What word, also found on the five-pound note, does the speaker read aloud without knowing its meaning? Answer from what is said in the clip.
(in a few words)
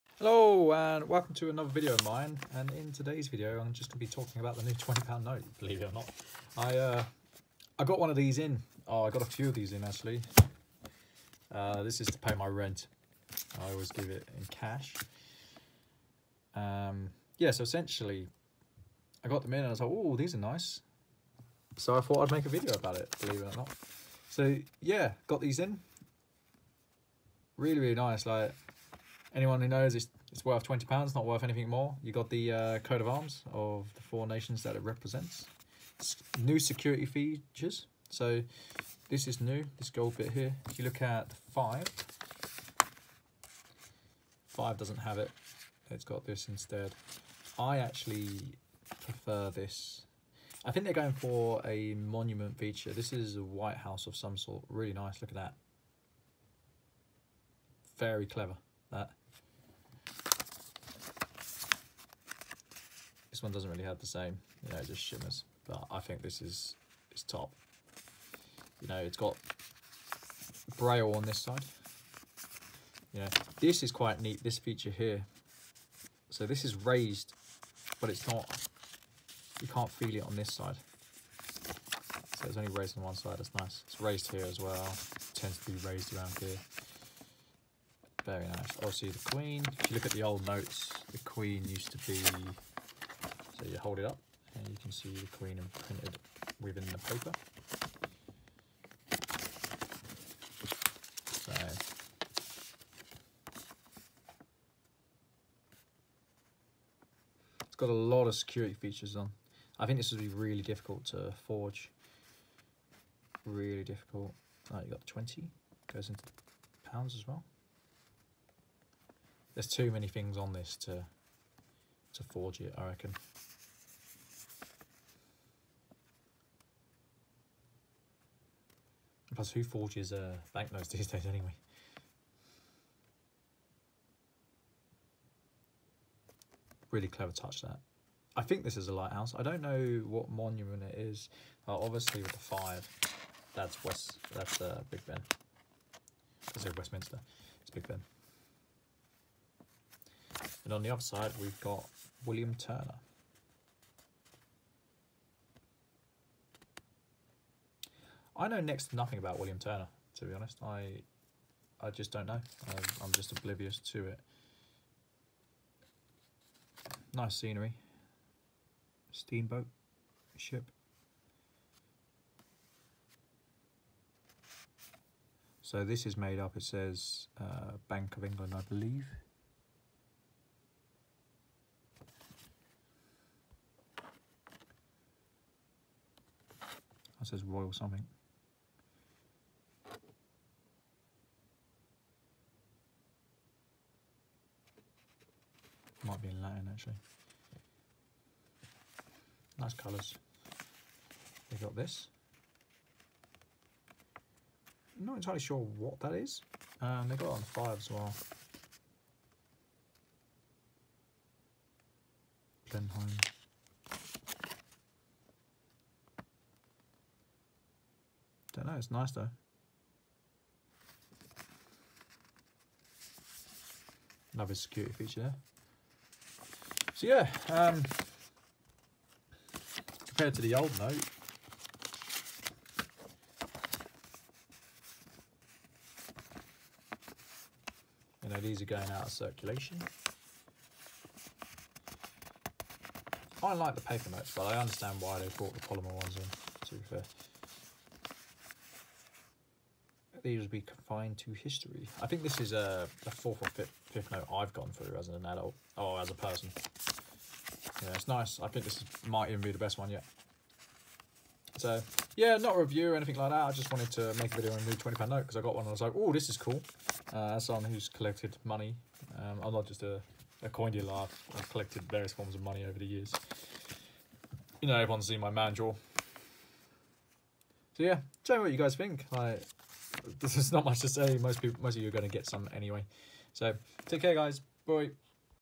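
Blenheim.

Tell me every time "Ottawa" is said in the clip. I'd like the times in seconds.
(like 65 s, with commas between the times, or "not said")
not said.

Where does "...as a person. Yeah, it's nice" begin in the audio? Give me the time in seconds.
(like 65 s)
255 s.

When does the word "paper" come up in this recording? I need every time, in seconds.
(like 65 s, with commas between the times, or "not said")
96 s, 243 s.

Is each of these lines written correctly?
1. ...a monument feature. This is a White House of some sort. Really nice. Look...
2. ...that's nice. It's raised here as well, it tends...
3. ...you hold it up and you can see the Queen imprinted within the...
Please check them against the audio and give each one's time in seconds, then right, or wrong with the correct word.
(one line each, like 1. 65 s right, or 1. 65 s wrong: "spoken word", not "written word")
1. 51 s right
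2. 83 s right
3. 93 s right.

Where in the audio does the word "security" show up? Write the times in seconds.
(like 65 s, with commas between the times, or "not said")
36 s, 108 s, 224 s.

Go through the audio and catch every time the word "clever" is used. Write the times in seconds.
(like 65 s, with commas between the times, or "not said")
58 s, 137 s.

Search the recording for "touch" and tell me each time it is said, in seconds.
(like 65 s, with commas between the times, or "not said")
137 s.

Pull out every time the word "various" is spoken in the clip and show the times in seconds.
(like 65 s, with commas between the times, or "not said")
271 s.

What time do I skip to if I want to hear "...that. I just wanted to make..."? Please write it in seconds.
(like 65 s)
263 s.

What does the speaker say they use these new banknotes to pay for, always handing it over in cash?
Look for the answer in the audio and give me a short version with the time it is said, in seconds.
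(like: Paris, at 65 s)
rent, at 12 s.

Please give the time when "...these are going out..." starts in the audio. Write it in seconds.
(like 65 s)
238 s.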